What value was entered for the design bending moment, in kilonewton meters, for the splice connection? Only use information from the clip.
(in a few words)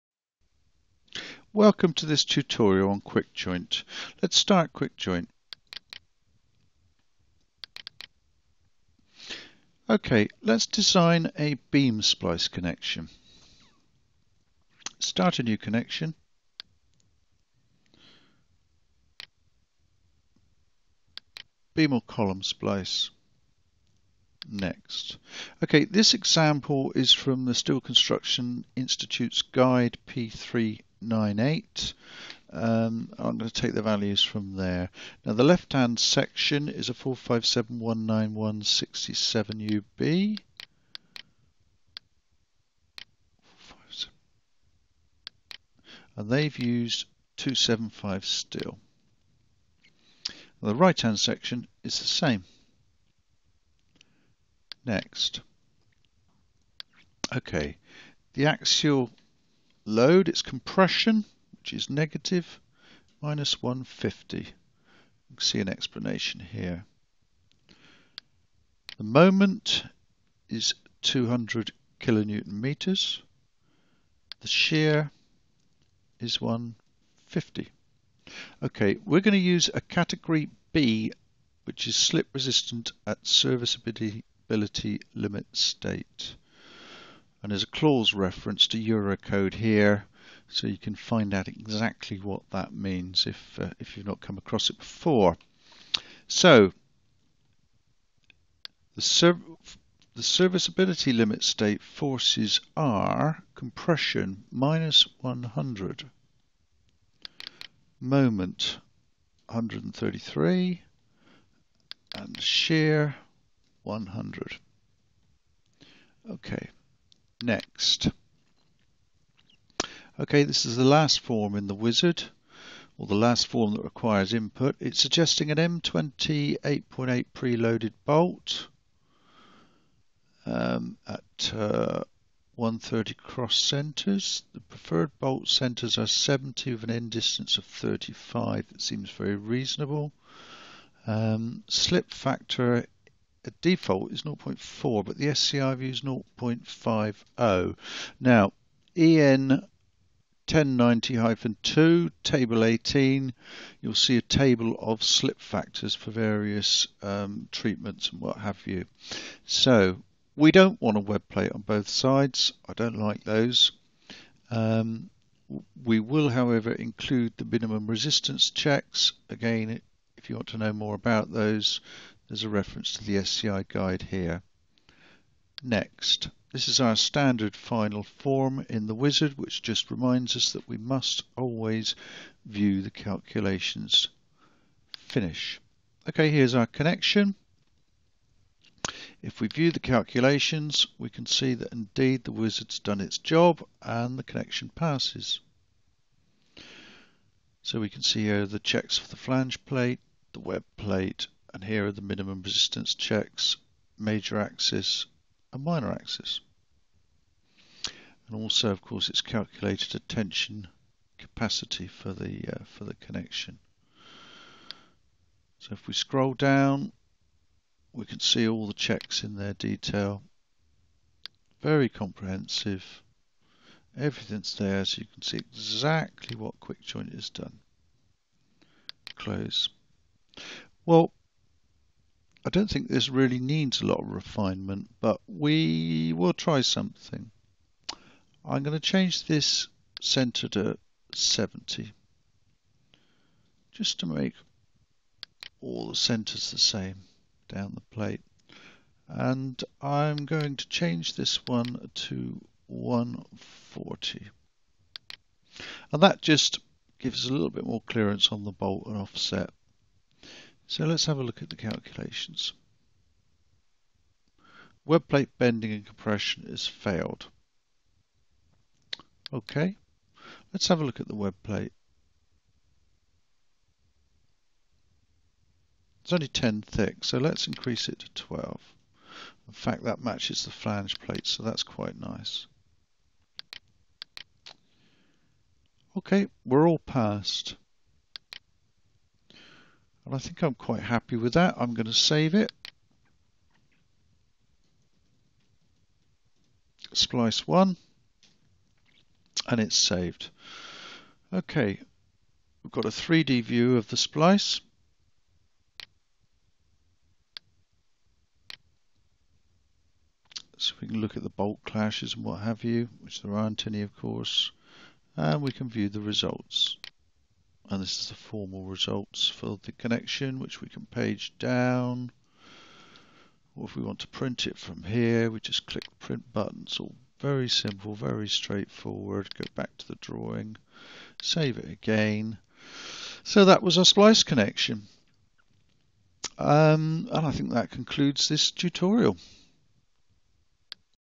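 200.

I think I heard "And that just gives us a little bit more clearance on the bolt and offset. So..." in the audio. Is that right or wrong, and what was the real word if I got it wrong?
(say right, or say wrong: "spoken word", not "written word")
right.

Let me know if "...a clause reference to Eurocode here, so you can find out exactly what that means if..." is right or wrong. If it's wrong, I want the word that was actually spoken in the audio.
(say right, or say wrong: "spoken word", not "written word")
right.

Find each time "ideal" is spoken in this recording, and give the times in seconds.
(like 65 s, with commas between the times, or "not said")
not said.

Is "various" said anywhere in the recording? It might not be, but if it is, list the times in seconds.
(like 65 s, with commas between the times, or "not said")
156 s.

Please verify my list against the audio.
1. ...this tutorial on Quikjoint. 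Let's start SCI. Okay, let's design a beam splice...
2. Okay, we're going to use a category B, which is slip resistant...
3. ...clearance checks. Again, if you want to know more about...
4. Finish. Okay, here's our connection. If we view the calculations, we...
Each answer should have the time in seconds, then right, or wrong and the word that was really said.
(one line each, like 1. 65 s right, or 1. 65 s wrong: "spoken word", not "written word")
1. 2 s wrong: "Quikjoint", not "SCI"
2. 78 s right
3. 167 s wrong: "resistance", not "clearance"
4. 184 s right.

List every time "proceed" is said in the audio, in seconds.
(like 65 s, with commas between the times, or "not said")
not said.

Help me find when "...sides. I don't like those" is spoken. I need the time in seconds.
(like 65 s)
161 s.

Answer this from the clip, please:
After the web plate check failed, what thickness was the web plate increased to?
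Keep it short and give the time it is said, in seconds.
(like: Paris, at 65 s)
12, at 278 s.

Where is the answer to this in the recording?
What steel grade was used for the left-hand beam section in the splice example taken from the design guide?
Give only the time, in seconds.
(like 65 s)
47 s.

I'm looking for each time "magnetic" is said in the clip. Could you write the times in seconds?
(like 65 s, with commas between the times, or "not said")
not said.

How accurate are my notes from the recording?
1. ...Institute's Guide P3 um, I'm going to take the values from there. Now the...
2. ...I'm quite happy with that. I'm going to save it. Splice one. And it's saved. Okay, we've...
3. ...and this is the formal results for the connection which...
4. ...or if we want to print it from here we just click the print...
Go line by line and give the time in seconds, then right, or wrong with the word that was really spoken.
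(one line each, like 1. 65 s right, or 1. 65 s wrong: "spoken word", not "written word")
1. 28 s right
2. 290 s right
3. 317 s right
4. 323 s right.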